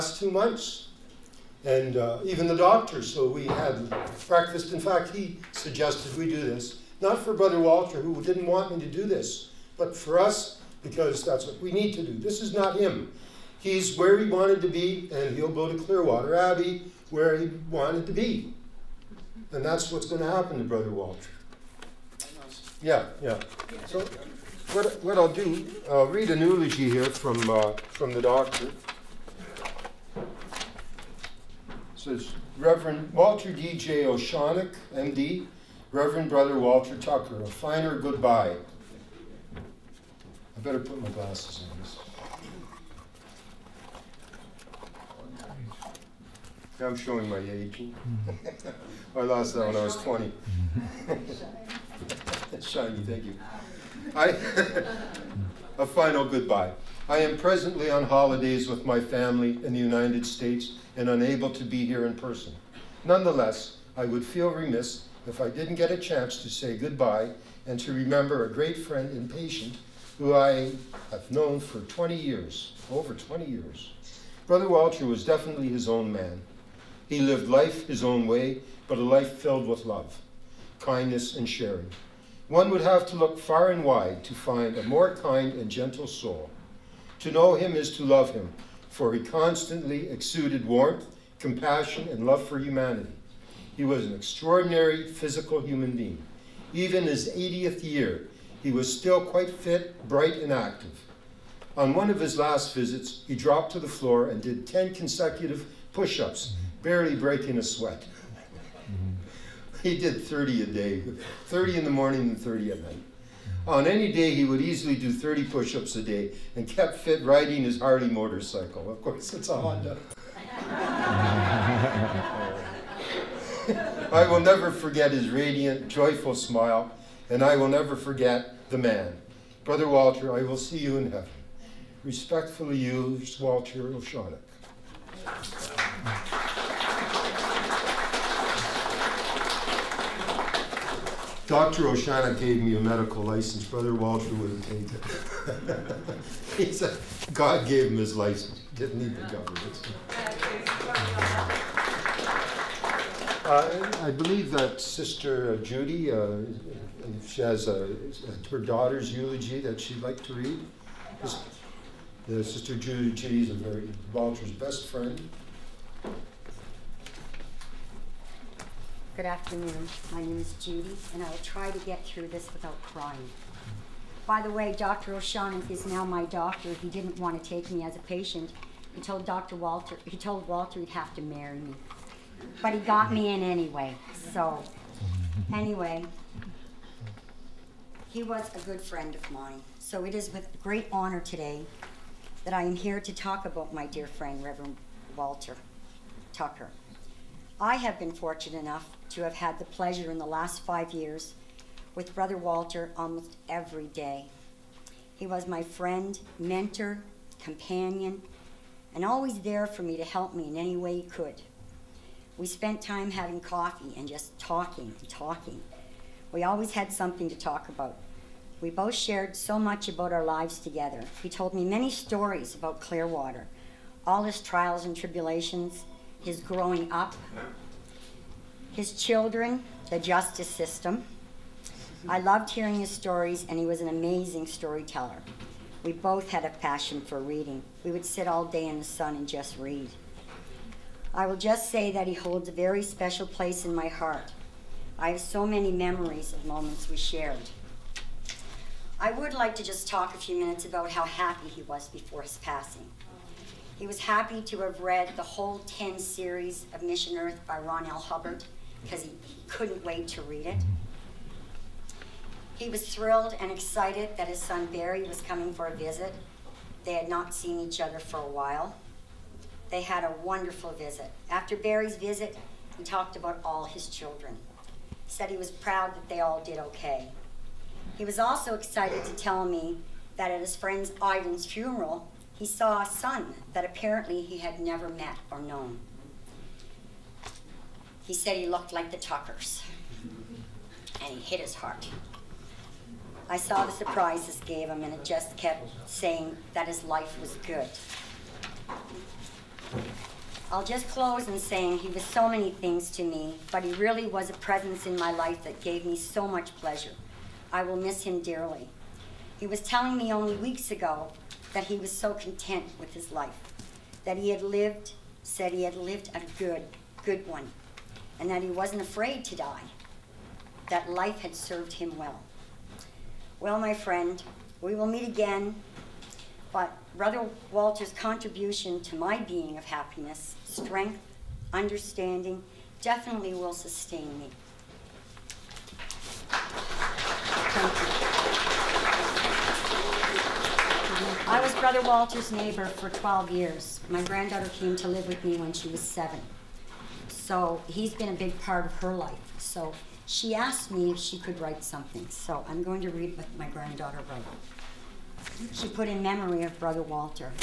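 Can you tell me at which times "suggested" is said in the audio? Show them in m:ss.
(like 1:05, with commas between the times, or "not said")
0:05.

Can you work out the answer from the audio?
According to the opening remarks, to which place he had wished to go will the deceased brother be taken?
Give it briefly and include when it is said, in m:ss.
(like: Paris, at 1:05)
Clearwater Abbey, at 0:15.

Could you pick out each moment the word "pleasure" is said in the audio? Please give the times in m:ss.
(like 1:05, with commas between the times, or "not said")
3:19, 5:06.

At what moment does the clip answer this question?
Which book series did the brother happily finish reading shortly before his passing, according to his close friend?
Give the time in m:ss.
4:16.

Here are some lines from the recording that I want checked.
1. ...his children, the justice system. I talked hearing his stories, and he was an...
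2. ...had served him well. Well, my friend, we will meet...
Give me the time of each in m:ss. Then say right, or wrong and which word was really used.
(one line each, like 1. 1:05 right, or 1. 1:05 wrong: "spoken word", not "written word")
1. 3:48 wrong: "loved", not "talked"
2. 5:21 right.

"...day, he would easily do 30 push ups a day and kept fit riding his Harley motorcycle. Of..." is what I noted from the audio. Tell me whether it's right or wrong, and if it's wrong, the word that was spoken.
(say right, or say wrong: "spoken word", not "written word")
right.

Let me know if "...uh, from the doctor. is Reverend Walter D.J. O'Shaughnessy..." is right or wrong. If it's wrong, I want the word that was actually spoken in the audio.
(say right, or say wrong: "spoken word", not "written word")
right.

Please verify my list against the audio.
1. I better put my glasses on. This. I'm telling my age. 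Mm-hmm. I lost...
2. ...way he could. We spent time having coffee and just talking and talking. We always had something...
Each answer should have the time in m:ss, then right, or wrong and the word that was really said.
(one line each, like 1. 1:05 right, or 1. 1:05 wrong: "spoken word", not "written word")
1. 0:39 wrong: "showing", not "telling"
2. 3:30 right.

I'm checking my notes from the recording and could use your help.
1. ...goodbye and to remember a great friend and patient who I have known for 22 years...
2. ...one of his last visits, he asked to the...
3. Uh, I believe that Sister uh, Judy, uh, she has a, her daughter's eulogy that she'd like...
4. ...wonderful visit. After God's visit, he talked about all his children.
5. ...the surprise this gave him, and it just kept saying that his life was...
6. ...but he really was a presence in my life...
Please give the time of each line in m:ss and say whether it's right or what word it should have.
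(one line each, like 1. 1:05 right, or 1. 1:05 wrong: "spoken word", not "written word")
1. 1:06 wrong: "20", not "22"
2. 1:41 wrong: "dropped", not "asked"
3. 2:33 right
4. 4:30 wrong: "Barry", not "God"
5. 4:53 right
6. 5:03 right.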